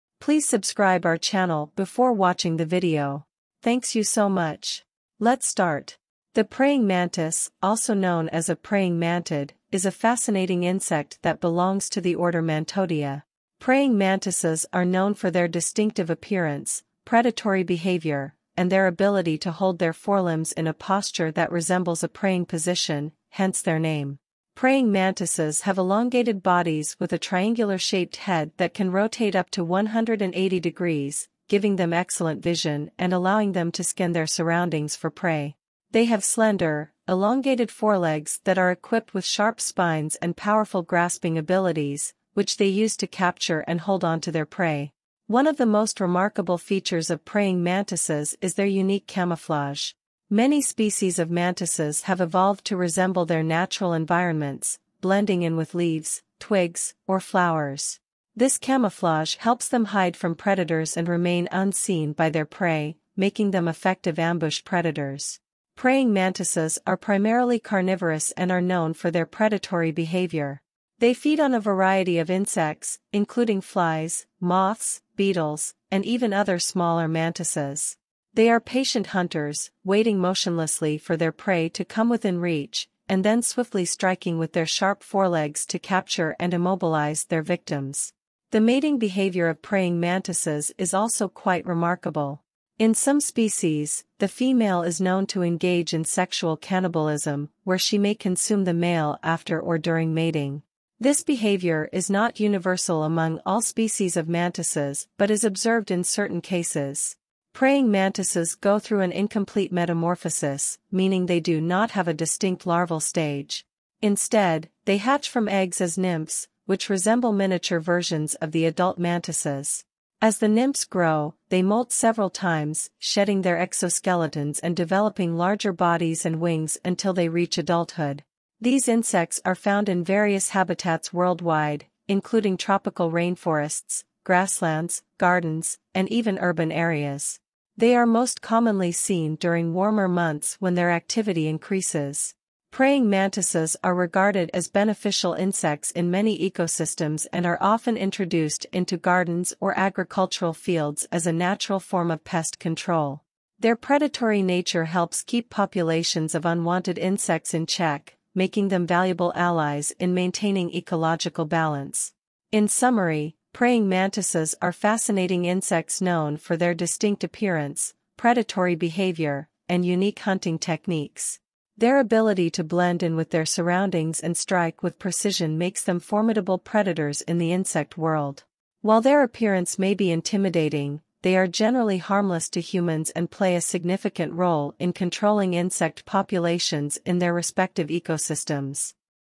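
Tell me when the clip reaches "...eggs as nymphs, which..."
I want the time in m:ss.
1:55.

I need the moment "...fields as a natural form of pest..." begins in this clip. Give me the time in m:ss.
2:30.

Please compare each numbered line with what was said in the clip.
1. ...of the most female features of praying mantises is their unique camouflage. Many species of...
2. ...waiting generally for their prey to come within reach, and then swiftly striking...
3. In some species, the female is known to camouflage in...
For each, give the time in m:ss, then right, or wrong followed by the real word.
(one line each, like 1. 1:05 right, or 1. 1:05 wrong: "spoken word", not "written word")
1. 0:45 wrong: "remarkable", not "female"
2. 1:19 wrong: "motionlessly", not "generally"
3. 1:32 wrong: "engage", not "camouflage".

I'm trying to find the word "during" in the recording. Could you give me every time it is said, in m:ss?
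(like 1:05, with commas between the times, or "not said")
1:39, 2:19.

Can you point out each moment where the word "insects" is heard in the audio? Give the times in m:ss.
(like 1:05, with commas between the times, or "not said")
0:10, 1:12, 2:08, 2:25, 2:36, 2:45, 2:57, 3:05.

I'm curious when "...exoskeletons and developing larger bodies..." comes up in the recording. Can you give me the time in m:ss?
2:03.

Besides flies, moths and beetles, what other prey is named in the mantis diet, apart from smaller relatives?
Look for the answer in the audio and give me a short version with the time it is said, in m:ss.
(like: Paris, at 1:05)
smaller mantises, at 1:16.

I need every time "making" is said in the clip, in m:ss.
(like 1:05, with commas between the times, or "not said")
1:03, 2:38.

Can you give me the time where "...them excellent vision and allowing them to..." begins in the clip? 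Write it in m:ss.
0:31.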